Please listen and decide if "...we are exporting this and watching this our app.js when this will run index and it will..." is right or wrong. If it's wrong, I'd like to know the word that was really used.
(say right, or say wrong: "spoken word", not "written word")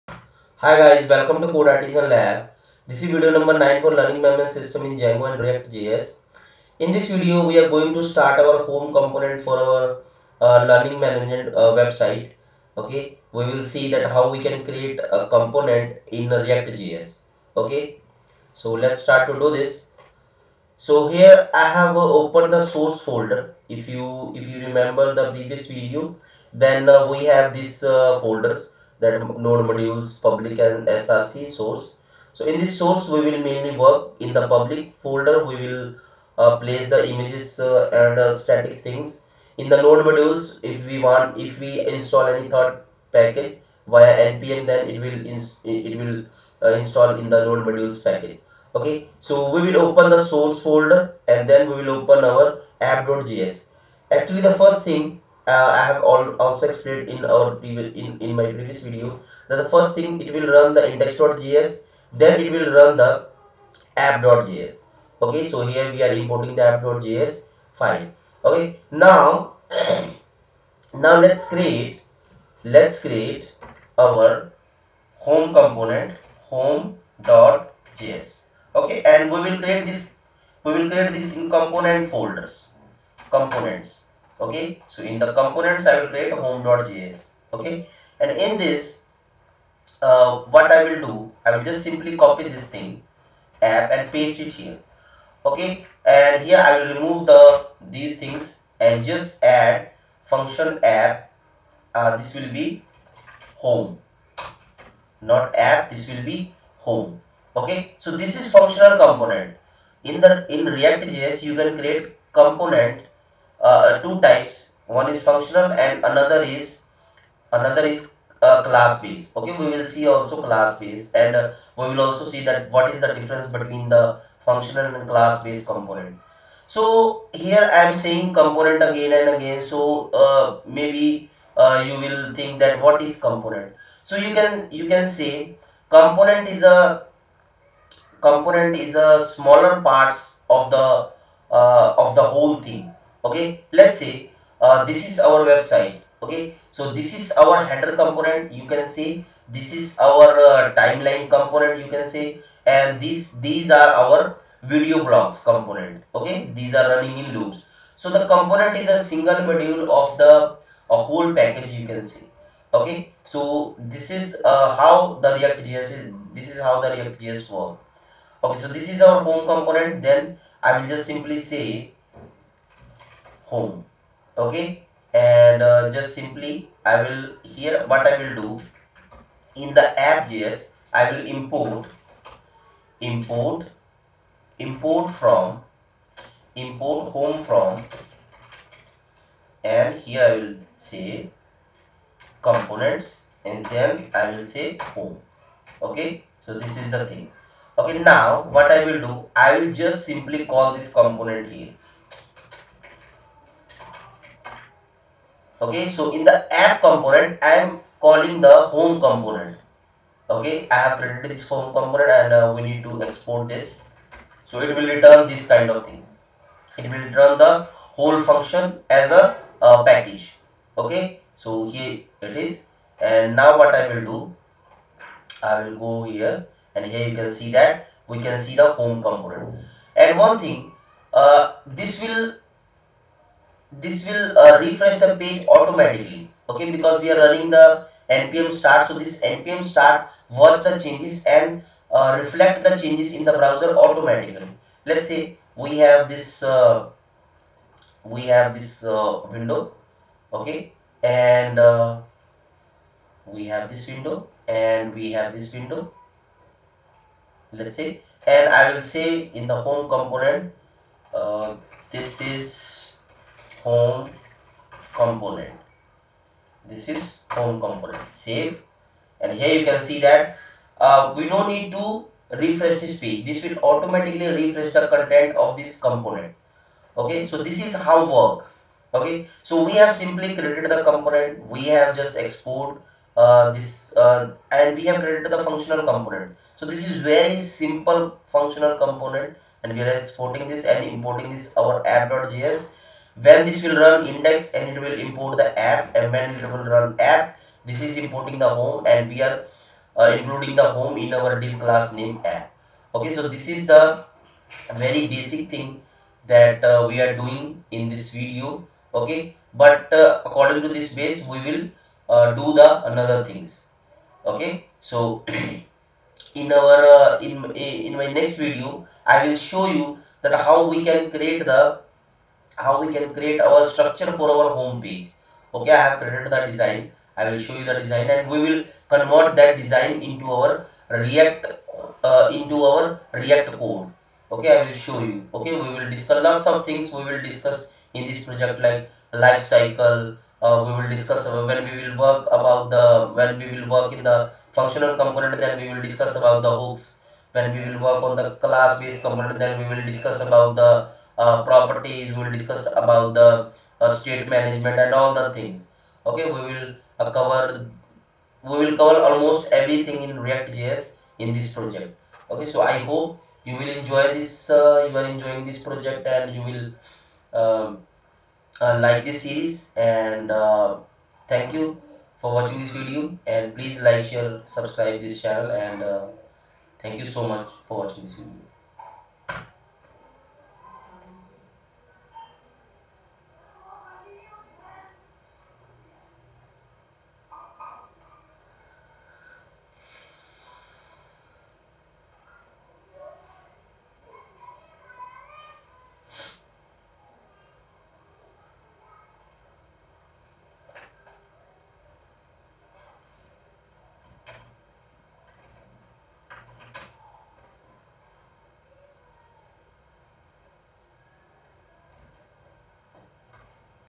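wrong: "importing", not "watching".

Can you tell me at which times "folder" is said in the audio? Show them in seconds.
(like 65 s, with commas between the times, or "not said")
23 s, 28 s, 35 s, 50 s, 82 s.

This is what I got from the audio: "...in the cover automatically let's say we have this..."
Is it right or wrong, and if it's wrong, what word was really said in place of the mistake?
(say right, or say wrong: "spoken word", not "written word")
wrong: "browser", not "cover".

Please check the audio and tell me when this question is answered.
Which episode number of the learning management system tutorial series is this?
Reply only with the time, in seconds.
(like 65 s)
3 s.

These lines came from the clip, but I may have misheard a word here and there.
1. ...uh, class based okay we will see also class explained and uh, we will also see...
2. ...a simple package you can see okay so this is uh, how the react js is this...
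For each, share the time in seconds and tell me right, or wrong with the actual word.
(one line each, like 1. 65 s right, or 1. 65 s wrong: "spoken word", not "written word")
1. 118 s wrong: "based", not "explained"
2. 160 s wrong: "whole", not "simple".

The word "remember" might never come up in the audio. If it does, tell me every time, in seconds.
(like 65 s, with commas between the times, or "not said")
24 s.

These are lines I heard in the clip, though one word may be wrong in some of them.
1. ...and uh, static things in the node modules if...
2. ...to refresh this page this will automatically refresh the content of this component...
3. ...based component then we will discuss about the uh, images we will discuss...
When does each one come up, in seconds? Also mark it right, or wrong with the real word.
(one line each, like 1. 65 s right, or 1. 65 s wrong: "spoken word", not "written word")
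1. 38 s right
2. 271 s right
3. 348 s wrong: "properties", not "images".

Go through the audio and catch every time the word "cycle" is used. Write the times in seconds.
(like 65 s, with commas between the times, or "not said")
339 s.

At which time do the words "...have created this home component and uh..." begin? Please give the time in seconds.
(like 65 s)
210 s.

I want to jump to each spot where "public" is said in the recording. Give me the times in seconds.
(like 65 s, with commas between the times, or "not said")
30 s, 34 s.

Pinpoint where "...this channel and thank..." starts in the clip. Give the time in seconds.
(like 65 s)
375 s.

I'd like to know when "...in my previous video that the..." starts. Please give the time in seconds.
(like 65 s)
58 s.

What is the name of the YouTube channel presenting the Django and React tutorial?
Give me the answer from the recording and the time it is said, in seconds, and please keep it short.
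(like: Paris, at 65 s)
CodeArtisan Lab, at 1 s.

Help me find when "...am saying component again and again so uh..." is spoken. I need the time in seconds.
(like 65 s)
127 s.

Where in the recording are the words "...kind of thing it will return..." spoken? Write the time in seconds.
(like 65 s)
215 s.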